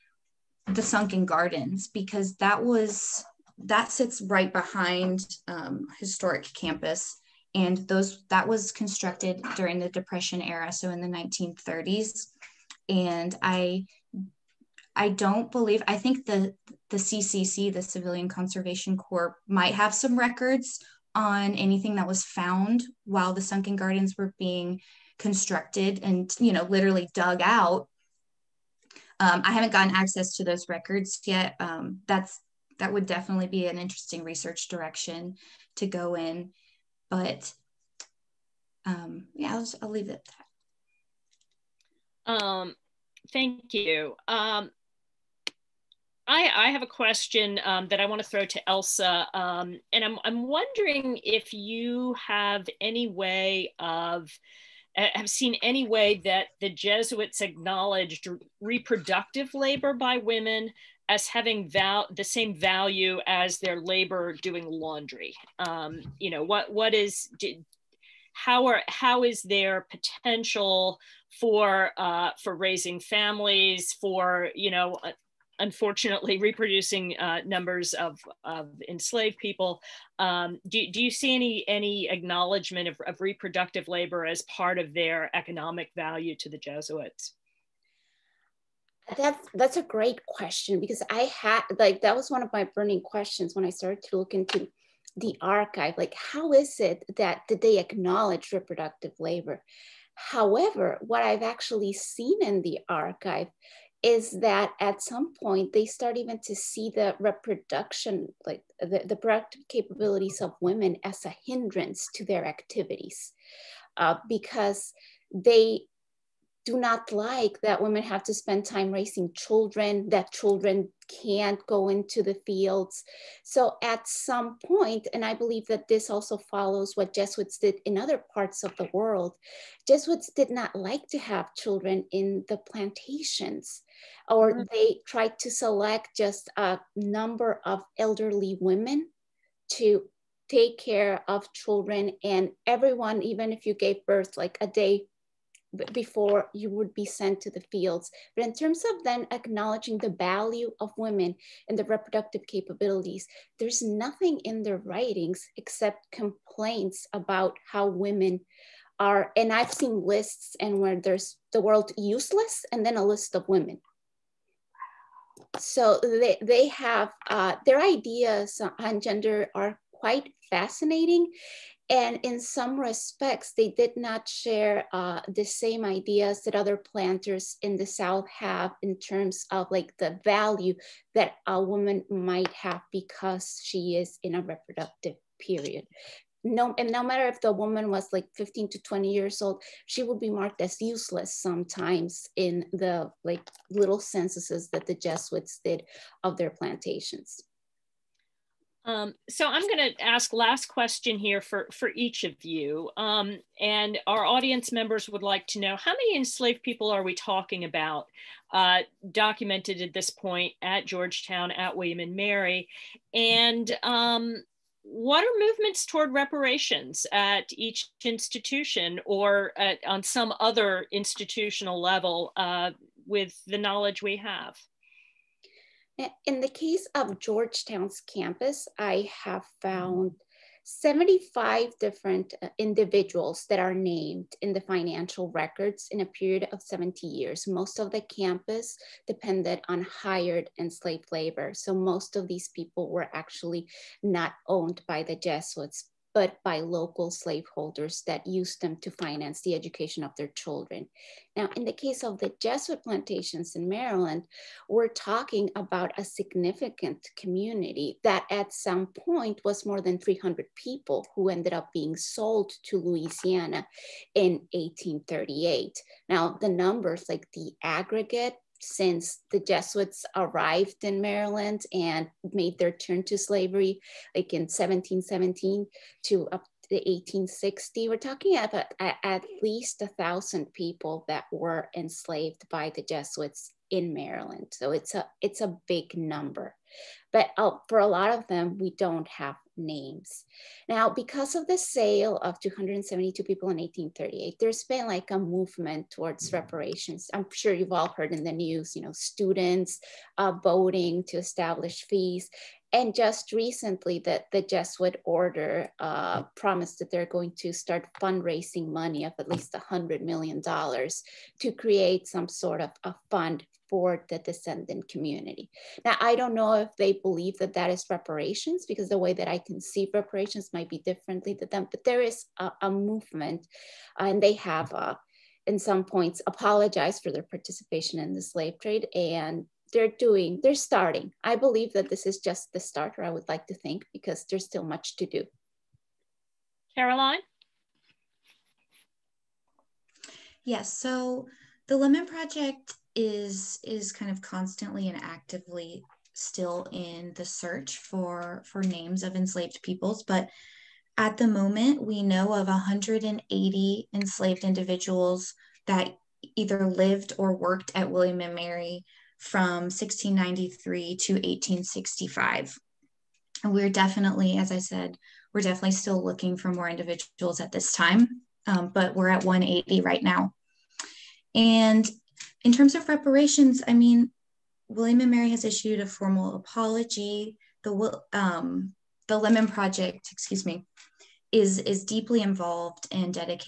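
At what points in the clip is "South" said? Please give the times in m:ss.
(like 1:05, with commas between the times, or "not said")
2:57.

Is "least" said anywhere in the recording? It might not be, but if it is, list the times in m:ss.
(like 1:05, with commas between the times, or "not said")
4:39, 5:09.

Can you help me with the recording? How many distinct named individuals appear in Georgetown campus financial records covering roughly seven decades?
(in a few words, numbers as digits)
75.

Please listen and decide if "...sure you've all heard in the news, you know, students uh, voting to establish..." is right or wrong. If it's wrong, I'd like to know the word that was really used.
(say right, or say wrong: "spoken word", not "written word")
right.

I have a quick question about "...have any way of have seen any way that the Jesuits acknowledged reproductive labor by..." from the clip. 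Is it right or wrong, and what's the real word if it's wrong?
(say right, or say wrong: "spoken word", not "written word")
right.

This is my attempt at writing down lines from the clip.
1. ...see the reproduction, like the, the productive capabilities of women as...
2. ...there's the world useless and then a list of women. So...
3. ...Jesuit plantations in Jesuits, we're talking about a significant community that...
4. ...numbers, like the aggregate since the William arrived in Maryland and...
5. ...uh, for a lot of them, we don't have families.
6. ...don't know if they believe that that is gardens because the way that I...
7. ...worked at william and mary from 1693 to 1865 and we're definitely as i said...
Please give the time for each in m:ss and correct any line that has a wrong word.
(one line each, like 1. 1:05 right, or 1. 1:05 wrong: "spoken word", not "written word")
1. 1:46 right
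2. 2:40 right
3. 4:12 wrong: "Maryland", not "Jesuits"
4. 4:26 wrong: "Jesuits", not "William"
5. 4:47 wrong: "names", not "families"
6. 5:16 wrong: "reparations", not "gardens"
7. 5:57 right.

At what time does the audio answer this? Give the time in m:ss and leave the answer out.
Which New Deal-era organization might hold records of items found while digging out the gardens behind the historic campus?
0:17.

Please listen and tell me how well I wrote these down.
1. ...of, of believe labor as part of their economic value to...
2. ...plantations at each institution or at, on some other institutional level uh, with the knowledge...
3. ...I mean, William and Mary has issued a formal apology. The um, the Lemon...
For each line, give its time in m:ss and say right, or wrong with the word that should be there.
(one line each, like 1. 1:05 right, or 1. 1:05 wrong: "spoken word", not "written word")
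1. 1:22 wrong: "reproductive", not "believe"
2. 3:36 wrong: "reparations", not "plantations"
3. 6:13 right.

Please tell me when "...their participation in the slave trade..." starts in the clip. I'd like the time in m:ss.
5:27.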